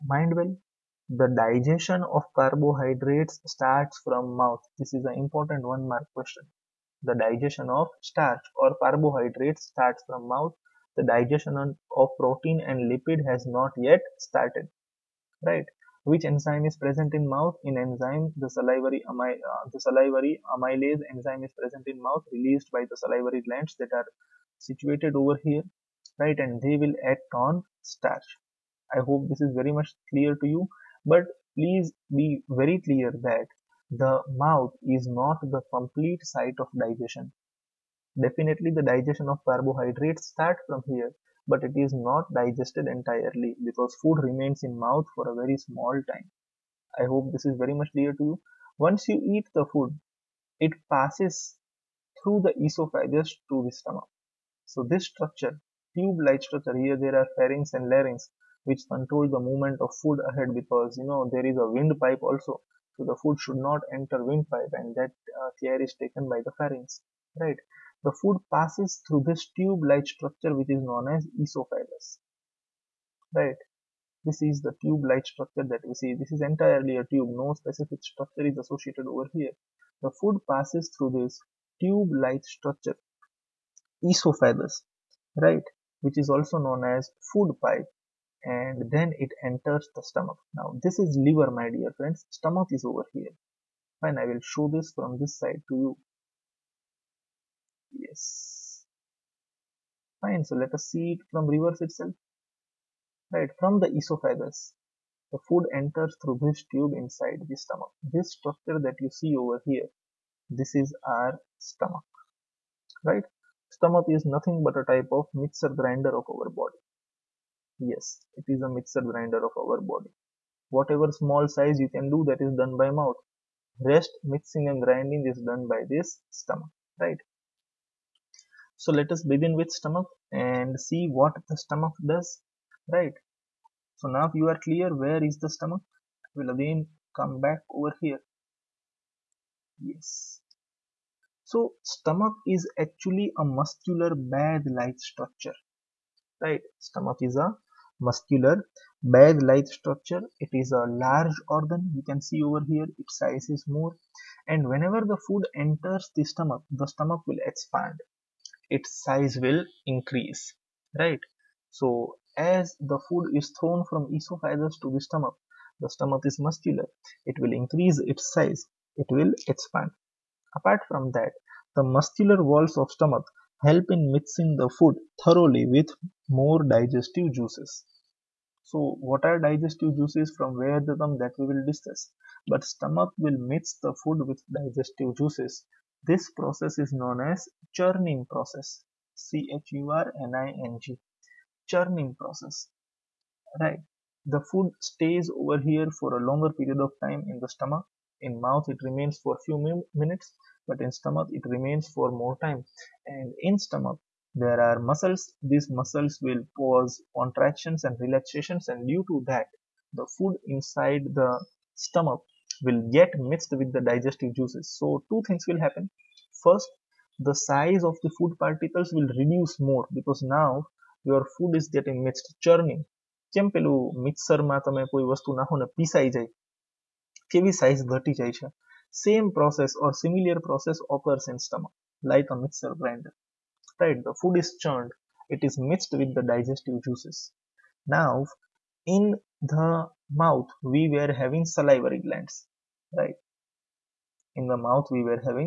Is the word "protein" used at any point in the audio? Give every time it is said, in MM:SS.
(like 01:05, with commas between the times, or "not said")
00:12.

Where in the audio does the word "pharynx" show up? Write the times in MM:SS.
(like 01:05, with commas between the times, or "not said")
00:57, 01:06.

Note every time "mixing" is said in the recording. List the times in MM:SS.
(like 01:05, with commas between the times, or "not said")
02:04, 02:54.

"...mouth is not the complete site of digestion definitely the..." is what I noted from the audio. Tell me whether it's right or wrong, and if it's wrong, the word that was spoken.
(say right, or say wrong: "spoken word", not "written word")
right.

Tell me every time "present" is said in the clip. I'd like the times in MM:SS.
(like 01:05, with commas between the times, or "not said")
00:16, 00:21.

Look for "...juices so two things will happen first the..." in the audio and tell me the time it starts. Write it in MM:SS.
03:34.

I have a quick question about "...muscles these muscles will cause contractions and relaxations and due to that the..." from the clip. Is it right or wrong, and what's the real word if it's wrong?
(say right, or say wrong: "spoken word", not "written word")
right.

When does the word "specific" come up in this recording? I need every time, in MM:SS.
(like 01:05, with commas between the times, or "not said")
01:17.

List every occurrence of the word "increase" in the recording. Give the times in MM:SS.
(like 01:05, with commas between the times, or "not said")
02:39, 02:47.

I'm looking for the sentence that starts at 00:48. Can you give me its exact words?
Once you eat the food, it passes through the esophagus to the stomach.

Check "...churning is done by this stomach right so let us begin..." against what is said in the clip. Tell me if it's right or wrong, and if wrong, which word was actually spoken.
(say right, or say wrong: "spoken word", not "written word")
wrong: "grinding", not "churning".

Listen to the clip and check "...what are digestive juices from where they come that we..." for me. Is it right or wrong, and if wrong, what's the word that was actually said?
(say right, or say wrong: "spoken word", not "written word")
right.